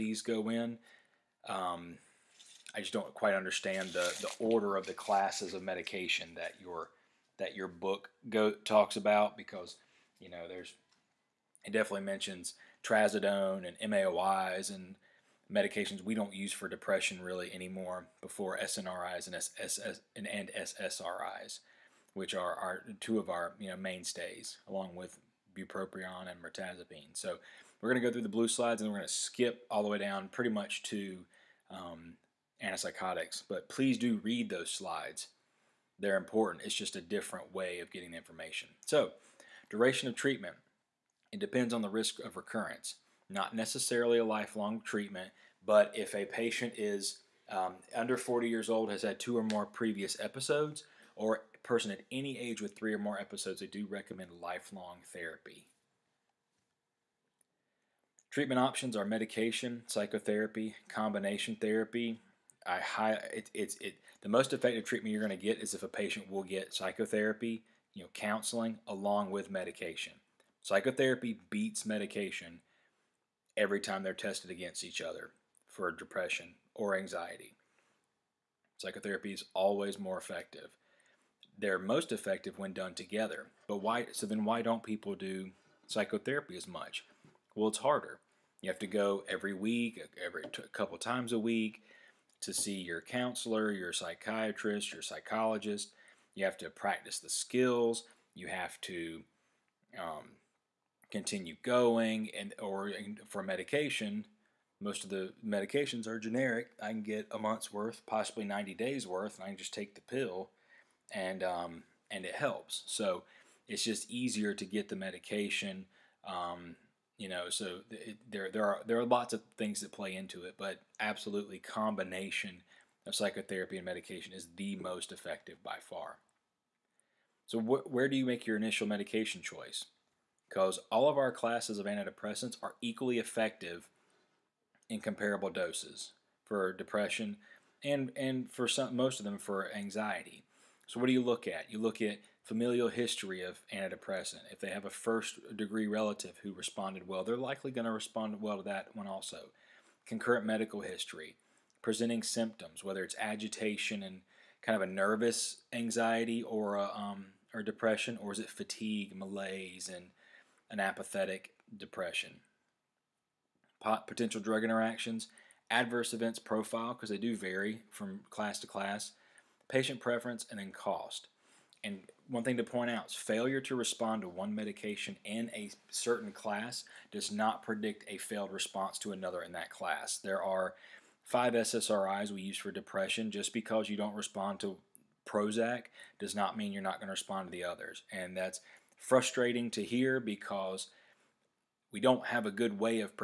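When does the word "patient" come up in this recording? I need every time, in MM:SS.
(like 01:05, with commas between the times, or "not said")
00:46, 01:05, 02:49.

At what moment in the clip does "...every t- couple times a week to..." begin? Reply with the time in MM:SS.
01:30.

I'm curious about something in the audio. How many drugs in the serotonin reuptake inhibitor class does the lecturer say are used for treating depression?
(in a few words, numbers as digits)
5.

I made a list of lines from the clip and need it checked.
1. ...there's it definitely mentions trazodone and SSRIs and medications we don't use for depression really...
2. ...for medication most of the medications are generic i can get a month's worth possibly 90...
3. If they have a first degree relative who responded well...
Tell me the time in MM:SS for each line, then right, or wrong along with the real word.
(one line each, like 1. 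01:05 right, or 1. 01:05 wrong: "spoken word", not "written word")
1. 00:10 wrong: "MAOIs", not "SSRIs"
2. 01:43 right
3. 02:24 right.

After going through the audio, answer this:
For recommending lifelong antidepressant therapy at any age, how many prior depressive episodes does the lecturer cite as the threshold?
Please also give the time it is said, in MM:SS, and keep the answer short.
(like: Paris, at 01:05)
3, at 00:52.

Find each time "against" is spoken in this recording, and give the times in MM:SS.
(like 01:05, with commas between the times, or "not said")
01:14.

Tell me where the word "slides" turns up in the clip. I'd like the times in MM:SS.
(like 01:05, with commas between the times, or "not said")
00:28, 00:34.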